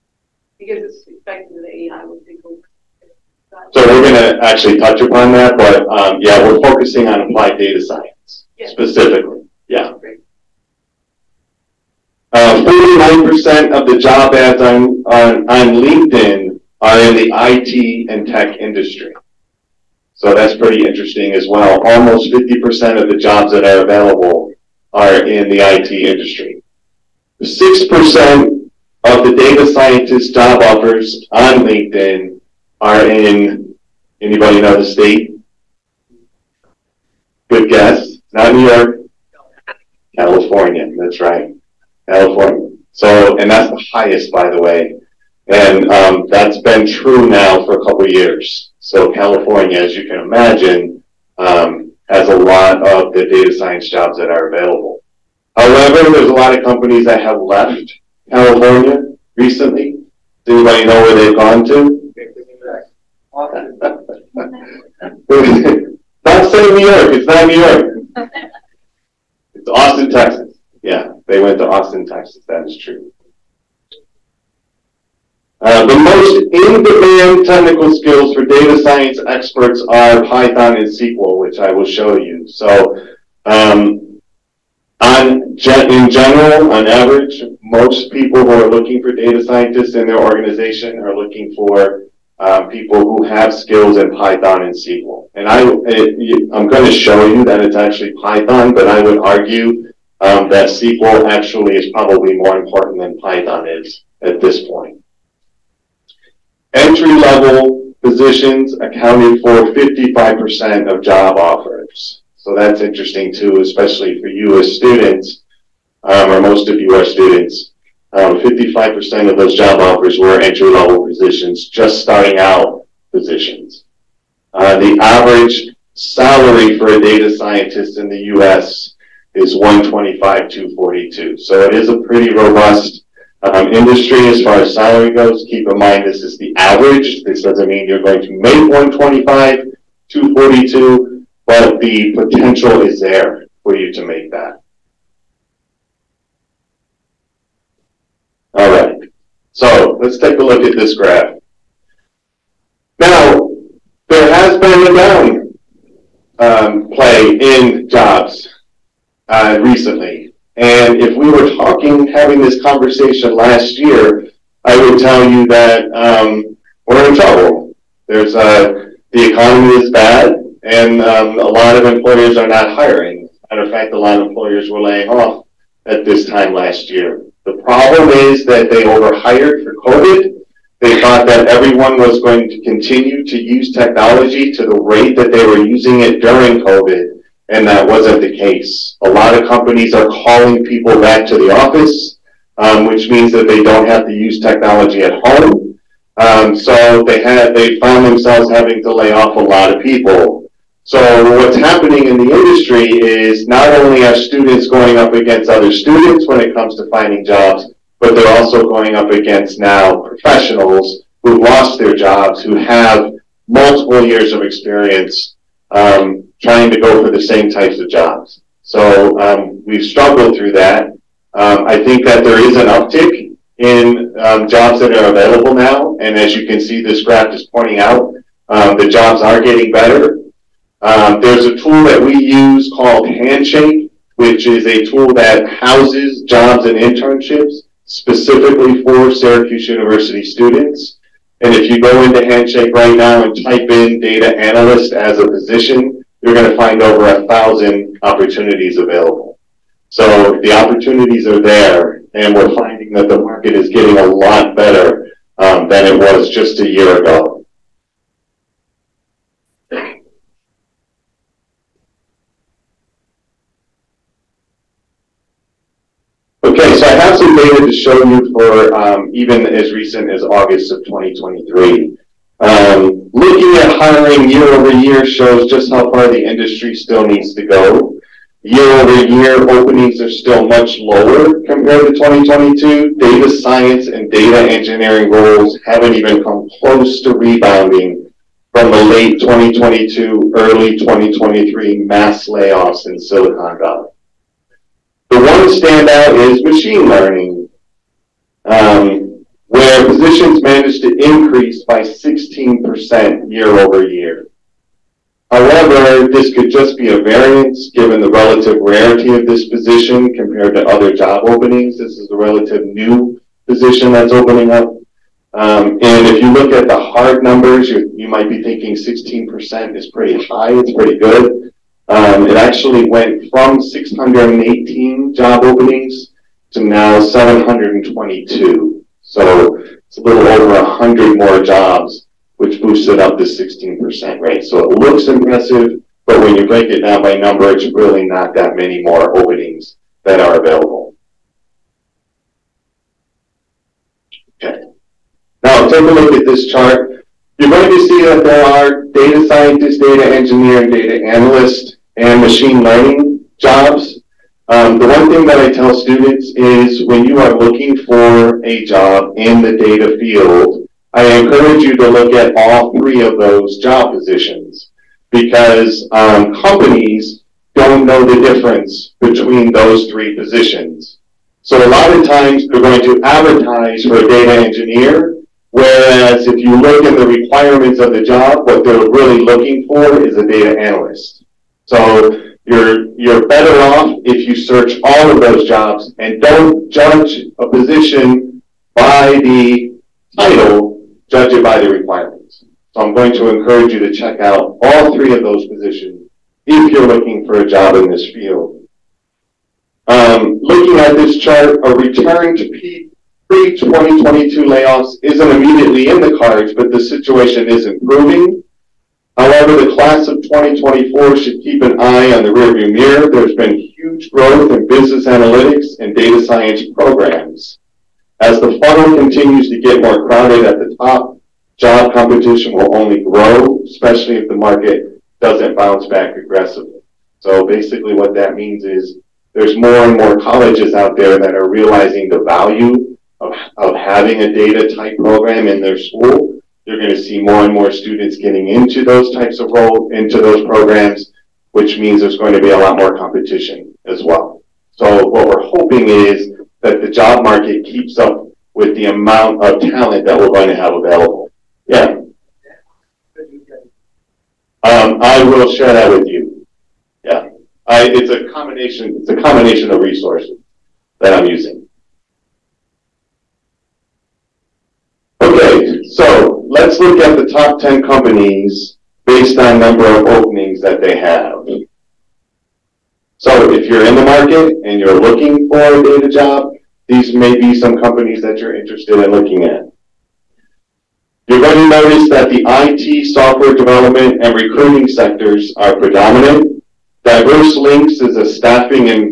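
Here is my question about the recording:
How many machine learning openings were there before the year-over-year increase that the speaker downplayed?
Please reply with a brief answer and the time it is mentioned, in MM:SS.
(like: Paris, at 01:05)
618, at 05:23.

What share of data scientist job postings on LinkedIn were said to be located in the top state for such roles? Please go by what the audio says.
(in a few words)
6%.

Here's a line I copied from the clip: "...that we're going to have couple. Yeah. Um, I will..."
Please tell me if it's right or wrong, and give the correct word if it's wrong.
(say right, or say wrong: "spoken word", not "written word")
wrong: "available", not "couple".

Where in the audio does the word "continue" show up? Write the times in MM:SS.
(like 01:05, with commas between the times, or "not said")
03:02, 06:58.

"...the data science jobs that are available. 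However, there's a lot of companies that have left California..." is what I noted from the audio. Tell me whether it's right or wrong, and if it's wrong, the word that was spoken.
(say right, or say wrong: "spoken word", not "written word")
right.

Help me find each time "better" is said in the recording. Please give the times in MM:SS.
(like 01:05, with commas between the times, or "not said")
03:49, 04:14, 06:23.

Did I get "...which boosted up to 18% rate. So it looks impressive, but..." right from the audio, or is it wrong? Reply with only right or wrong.
wrong.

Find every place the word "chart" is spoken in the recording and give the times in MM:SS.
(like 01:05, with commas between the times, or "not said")
05:46, 06:41.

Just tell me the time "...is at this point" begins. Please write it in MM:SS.
01:43.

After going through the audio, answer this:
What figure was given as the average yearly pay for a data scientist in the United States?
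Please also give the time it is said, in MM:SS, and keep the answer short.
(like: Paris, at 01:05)
$125,242, at 02:09.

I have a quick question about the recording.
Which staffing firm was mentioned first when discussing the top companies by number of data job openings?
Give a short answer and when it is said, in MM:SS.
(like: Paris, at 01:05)
Diverse Lynx, at 08:07.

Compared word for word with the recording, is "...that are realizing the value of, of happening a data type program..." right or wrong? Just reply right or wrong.
wrong.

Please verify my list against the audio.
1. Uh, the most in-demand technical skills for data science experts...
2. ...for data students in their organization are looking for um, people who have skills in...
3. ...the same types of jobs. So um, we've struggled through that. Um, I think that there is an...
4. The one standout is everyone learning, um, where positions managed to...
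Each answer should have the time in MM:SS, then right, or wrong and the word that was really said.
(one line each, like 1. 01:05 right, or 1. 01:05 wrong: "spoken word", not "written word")
1. 01:15 right
2. 01:29 wrong: "scientists", not "students"
3. 03:37 right
4. 04:55 wrong: "machine", not "everyone".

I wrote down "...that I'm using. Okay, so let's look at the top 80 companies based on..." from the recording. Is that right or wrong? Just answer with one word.
wrong.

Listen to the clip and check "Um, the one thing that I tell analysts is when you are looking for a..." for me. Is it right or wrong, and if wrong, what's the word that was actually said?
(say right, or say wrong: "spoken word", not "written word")
wrong: "students", not "analysts".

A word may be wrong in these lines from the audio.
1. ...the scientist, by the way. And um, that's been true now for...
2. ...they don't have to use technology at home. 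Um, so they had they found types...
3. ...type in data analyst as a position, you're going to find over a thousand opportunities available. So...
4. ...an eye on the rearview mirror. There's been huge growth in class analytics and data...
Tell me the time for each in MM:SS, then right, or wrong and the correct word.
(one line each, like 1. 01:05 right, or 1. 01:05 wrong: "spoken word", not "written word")
1. 00:43 wrong: "highest", not "scientist"
2. 03:13 wrong: "themselves", not "types"
3. 04:03 right
4. 06:51 wrong: "business", not "class".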